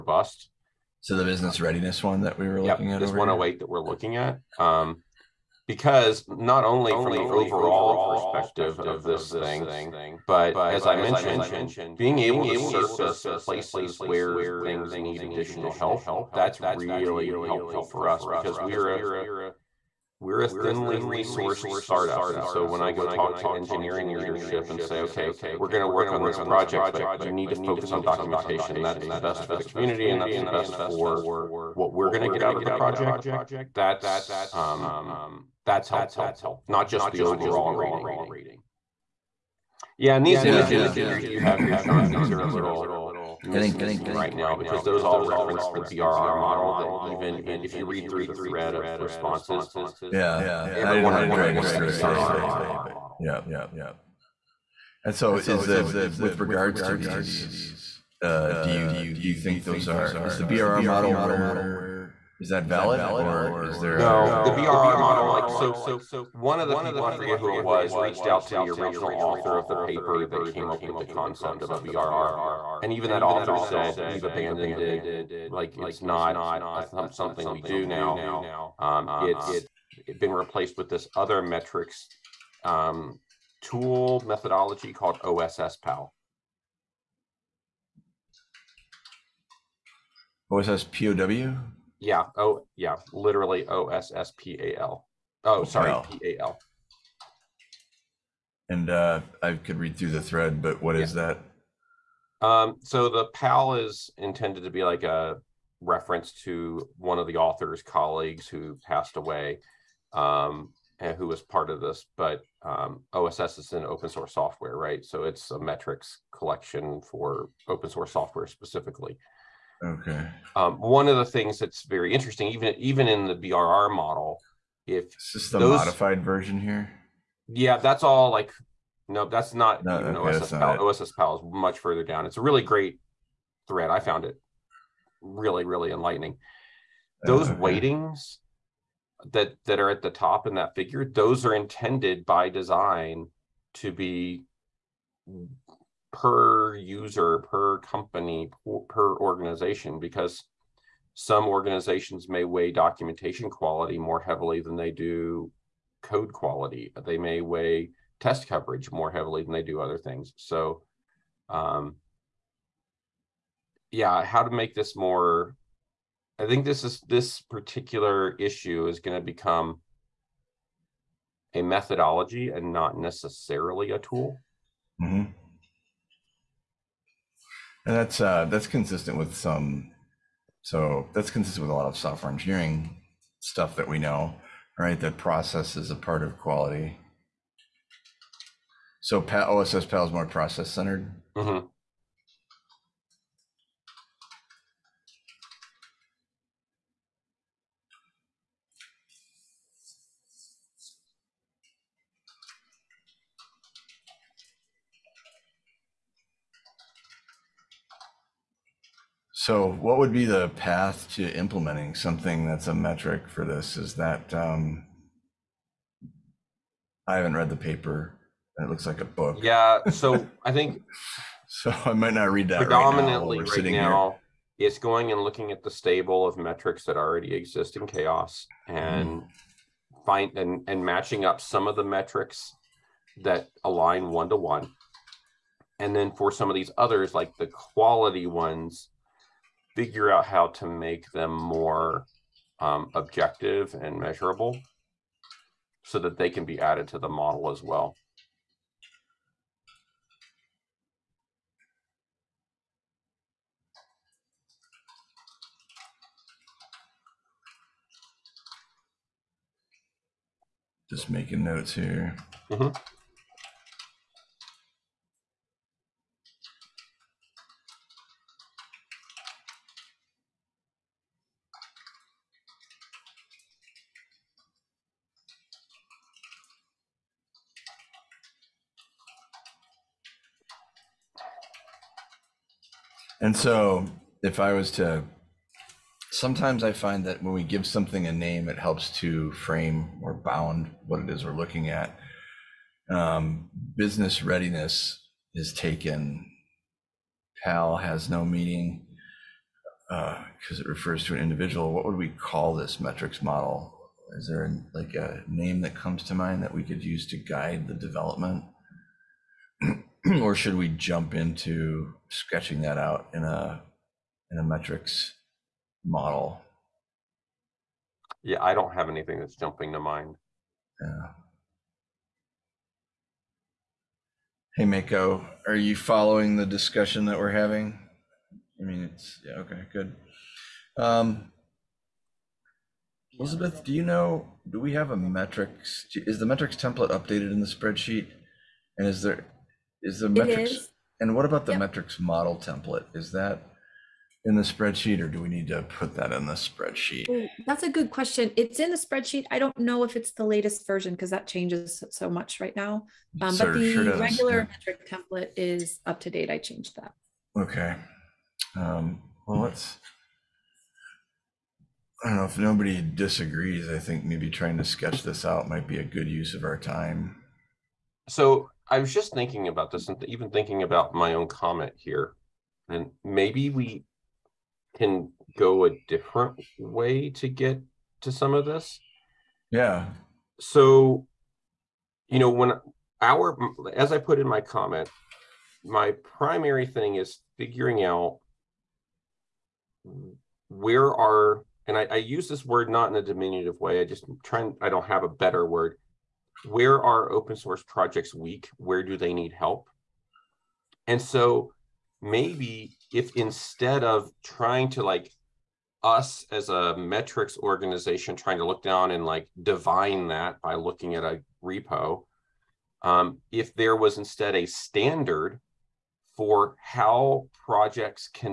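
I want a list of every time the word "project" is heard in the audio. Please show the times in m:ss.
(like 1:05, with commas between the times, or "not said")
0:26, 0:32, 6:37, 6:57.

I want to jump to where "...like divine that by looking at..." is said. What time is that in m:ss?
6:49.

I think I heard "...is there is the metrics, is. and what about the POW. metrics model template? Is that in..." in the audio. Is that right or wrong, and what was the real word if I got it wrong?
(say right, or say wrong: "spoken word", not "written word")
wrong: "Yep", not "POW".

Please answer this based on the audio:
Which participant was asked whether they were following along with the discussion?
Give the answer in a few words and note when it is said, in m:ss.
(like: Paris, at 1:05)
Mako, at 5:24.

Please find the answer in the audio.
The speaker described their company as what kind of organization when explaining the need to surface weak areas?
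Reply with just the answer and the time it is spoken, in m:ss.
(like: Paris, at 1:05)
thinly resourced startup, at 0:20.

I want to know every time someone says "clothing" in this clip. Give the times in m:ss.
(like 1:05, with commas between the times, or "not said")
not said.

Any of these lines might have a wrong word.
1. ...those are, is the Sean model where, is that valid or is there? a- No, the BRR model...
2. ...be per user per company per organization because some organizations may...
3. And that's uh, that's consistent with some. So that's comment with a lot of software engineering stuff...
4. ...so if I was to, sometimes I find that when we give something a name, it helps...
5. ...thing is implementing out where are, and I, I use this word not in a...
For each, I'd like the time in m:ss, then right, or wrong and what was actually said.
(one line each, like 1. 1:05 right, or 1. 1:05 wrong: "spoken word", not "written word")
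1. 0:59 wrong: "BRR", not "Sean"
2. 2:23 right
3. 2:57 wrong: "consistent", not "comment"
4. 4:43 right
5. 6:26 wrong: "figuring", not "implementing".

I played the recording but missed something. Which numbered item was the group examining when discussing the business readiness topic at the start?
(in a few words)
108.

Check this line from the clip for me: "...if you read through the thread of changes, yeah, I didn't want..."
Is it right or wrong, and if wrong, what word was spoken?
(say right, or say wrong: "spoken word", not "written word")
wrong: "responses", not "changes".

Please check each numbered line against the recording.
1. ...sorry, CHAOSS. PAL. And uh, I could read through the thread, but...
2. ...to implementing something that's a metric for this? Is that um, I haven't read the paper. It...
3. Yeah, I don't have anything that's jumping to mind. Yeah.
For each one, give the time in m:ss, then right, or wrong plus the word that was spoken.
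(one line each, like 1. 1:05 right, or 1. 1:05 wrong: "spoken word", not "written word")
1. 1:35 wrong: "PAL", not "CHAOSS"
2. 3:31 right
3. 5:18 right.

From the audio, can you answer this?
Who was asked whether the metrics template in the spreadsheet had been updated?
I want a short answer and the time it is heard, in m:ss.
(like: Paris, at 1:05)
Elizabeth, at 5:33.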